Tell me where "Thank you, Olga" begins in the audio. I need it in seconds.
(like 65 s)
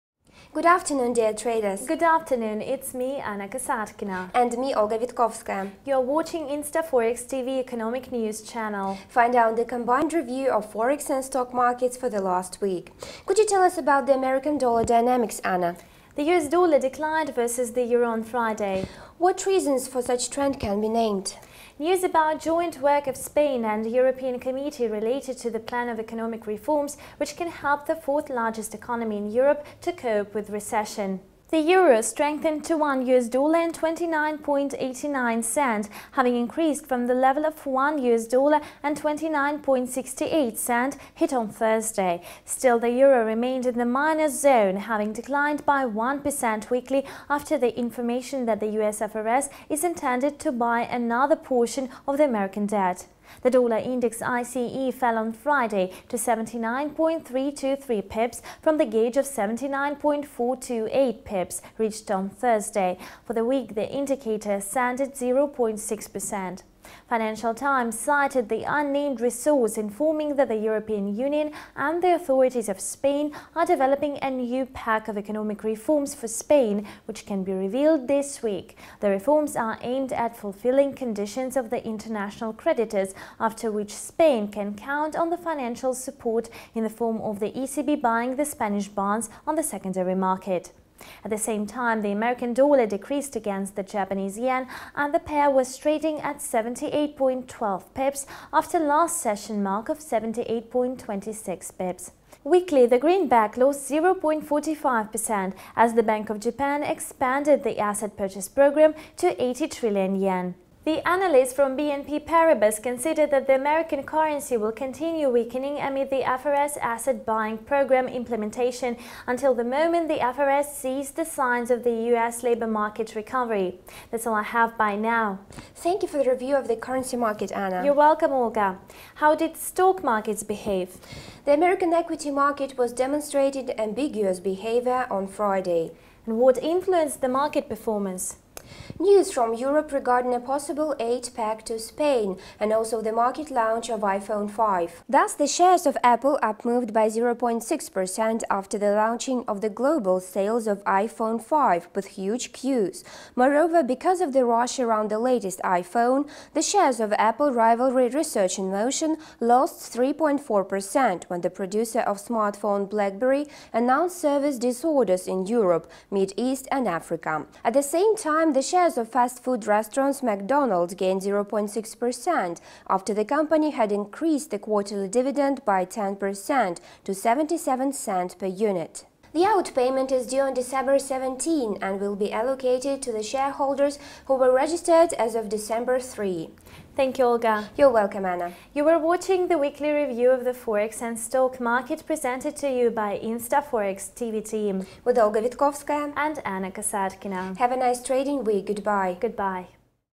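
186 s.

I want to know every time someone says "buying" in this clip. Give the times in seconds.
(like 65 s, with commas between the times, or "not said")
88 s, 117 s.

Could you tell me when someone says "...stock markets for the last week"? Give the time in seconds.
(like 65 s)
11 s.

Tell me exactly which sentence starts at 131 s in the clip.
The American equity market was demonstrated ambiguous behavior on Friday.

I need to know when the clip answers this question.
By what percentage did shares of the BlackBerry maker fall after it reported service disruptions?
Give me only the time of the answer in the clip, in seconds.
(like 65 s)
159 s.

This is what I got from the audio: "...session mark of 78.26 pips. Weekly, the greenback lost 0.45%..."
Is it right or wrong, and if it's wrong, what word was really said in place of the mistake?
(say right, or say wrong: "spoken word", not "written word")
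right.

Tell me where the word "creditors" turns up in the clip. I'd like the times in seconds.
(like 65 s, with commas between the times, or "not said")
82 s.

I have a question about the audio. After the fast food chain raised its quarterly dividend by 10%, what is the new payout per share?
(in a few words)
77 cents.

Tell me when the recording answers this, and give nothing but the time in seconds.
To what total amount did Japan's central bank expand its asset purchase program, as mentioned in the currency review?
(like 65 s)
109 s.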